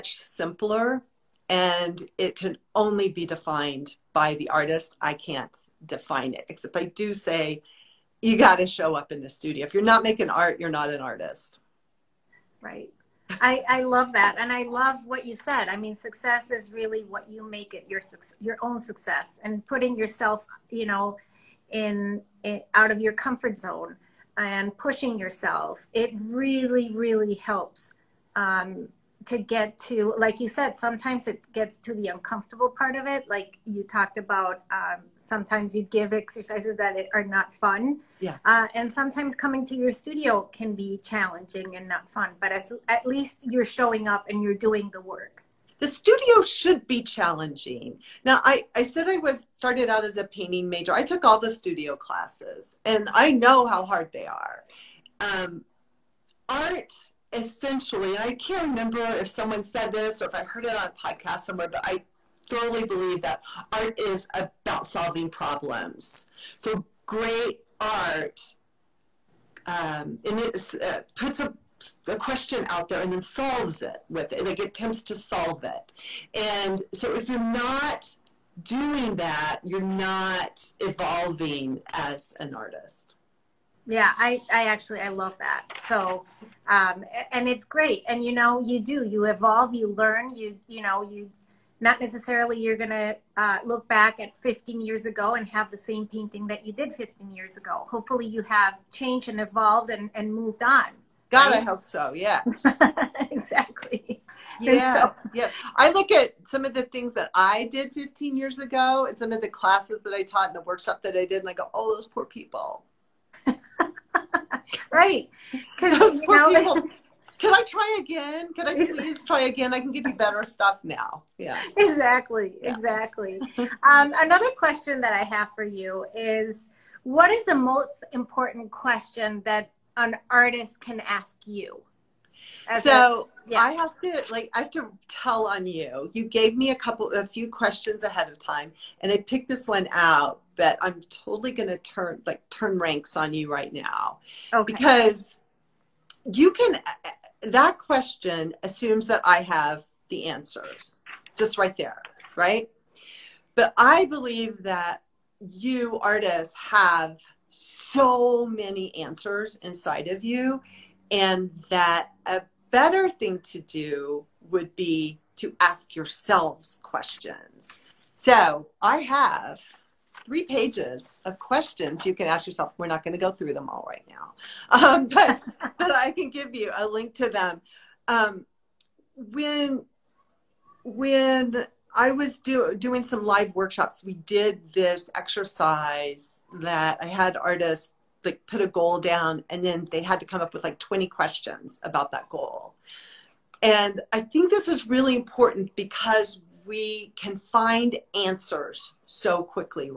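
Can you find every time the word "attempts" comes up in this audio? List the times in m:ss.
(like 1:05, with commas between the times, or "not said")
1:14.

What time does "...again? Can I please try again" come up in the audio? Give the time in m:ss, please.
1:58.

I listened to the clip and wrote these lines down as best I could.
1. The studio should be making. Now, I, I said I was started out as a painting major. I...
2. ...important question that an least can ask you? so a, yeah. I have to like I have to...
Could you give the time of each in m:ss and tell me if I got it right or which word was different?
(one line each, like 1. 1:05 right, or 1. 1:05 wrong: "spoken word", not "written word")
1. 0:45 wrong: "challenging", not "making"
2. 2:08 wrong: "artist", not "least".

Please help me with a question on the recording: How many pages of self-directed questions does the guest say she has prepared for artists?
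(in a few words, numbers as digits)
3.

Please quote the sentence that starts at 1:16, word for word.
And so if you're not doing that, you're not evolving as an artist.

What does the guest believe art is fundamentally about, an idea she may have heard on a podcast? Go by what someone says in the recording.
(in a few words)
Solving problems.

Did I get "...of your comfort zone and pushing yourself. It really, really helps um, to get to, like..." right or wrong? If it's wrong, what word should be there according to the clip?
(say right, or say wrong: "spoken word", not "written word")
right.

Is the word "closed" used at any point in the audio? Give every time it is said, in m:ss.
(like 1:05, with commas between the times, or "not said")
not said.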